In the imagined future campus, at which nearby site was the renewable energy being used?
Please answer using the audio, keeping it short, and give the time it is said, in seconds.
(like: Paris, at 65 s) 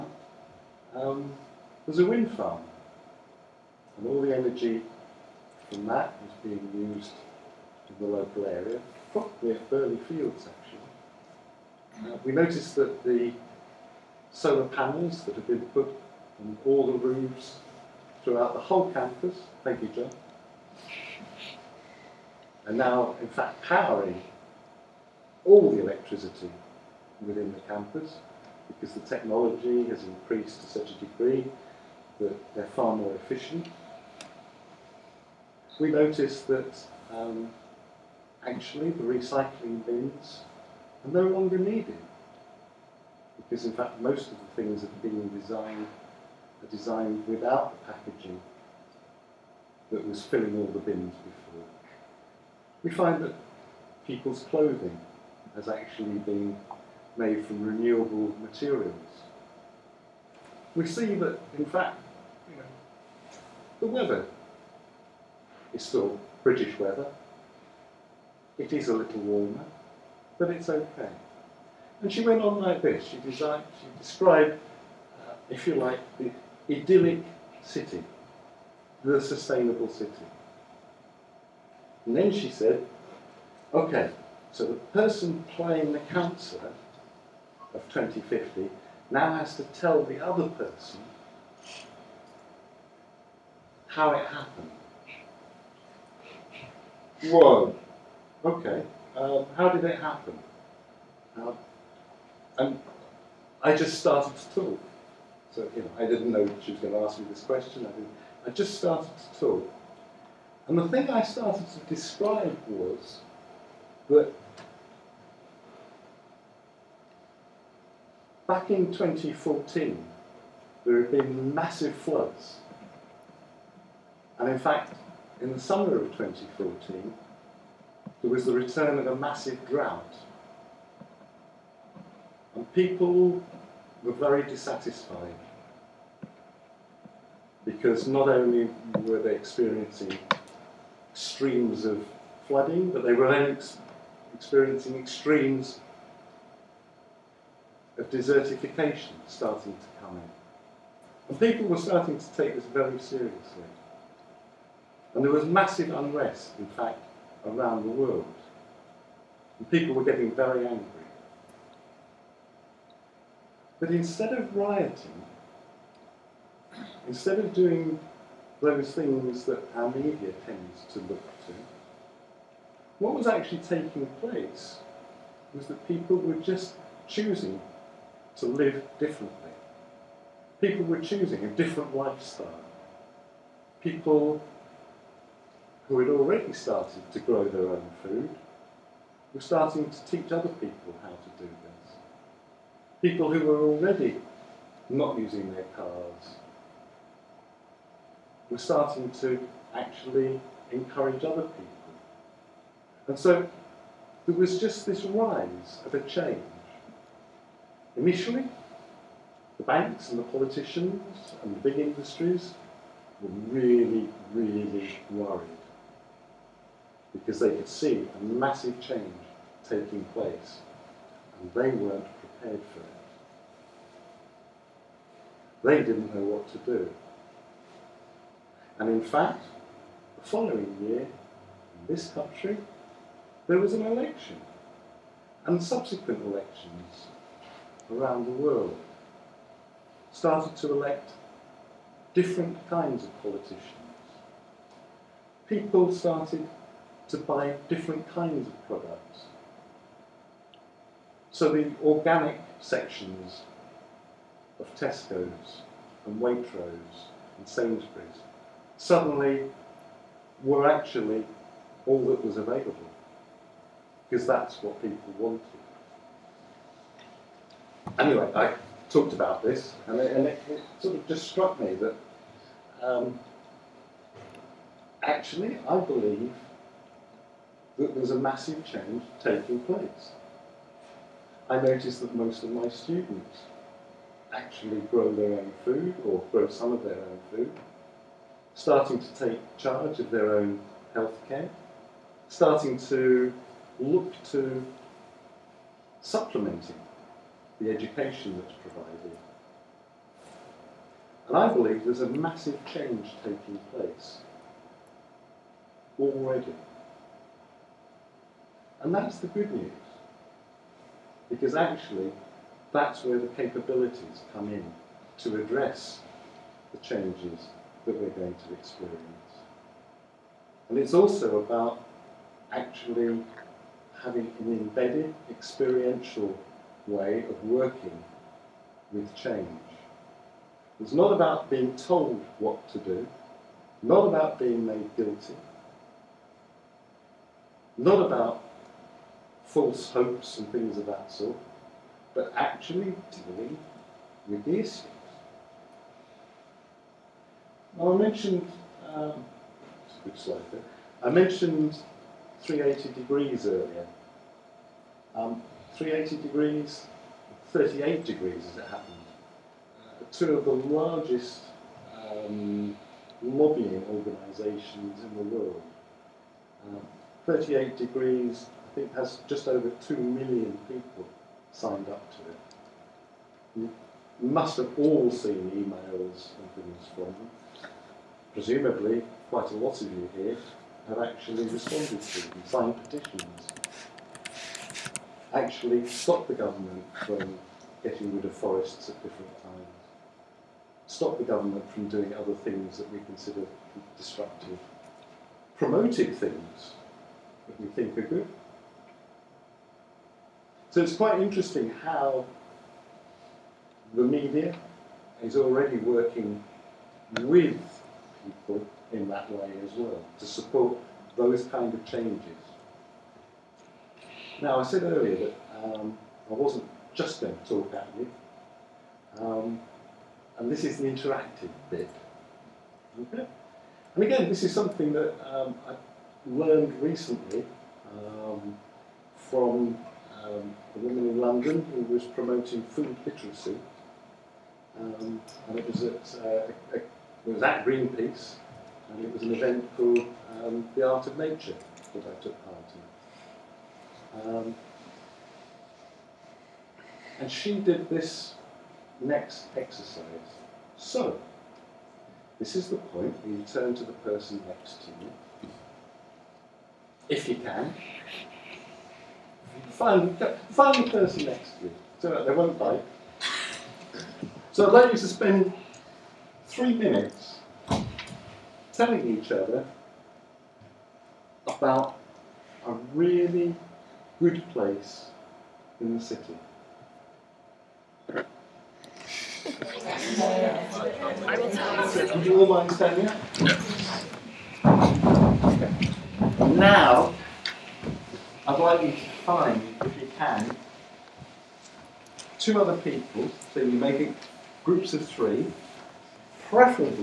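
Birley Fields, at 9 s.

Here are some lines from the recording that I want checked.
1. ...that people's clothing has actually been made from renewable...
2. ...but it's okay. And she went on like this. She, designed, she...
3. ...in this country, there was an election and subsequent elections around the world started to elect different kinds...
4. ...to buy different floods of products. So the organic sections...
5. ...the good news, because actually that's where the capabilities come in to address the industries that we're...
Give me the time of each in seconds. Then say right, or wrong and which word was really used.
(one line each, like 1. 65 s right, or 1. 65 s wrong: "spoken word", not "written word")
1. 53 s right
2. 70 s right
3. 230 s right
4. 247 s wrong: "kinds", not "floods"
5. 309 s wrong: "changes", not "industries".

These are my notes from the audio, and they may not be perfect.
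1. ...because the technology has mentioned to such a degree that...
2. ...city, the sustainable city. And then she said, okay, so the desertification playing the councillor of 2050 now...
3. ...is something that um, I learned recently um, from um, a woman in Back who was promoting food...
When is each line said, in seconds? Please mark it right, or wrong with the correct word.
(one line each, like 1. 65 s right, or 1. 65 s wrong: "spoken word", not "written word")
1. 28 s wrong: "increased", not "mentioned"
2. 77 s wrong: "person", not "desertification"
3. 424 s wrong: "London", not "Back".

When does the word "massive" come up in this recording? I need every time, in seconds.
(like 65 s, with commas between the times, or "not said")
121 s, 129 s, 155 s, 218 s, 278 s, 302 s.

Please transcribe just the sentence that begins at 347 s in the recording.
Now I mentioned, um, a good slide there, I mentioned 380 degrees earlier.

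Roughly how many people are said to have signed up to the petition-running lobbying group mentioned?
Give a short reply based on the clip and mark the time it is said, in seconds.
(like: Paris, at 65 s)
2 million, at 369 s.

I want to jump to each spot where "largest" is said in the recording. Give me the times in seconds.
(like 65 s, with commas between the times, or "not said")
360 s.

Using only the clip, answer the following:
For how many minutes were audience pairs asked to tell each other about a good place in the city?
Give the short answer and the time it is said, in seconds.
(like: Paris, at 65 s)
3, at 466 s.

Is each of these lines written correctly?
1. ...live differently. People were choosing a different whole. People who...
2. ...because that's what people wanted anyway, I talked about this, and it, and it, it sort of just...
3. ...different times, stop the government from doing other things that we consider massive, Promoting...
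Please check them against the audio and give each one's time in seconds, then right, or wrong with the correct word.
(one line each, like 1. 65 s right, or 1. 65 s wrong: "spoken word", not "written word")
1. 178 s wrong: "lifestyle", not "whole"
2. 264 s right
3. 389 s wrong: "destructive", not "massive".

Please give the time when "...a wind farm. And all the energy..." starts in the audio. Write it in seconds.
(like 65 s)
1 s.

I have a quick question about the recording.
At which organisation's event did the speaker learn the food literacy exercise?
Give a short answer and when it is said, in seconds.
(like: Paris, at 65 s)
Greenpeace, at 437 s.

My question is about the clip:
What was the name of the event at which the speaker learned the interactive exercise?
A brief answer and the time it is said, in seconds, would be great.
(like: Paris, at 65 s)
The Art of Nature, at 440 s.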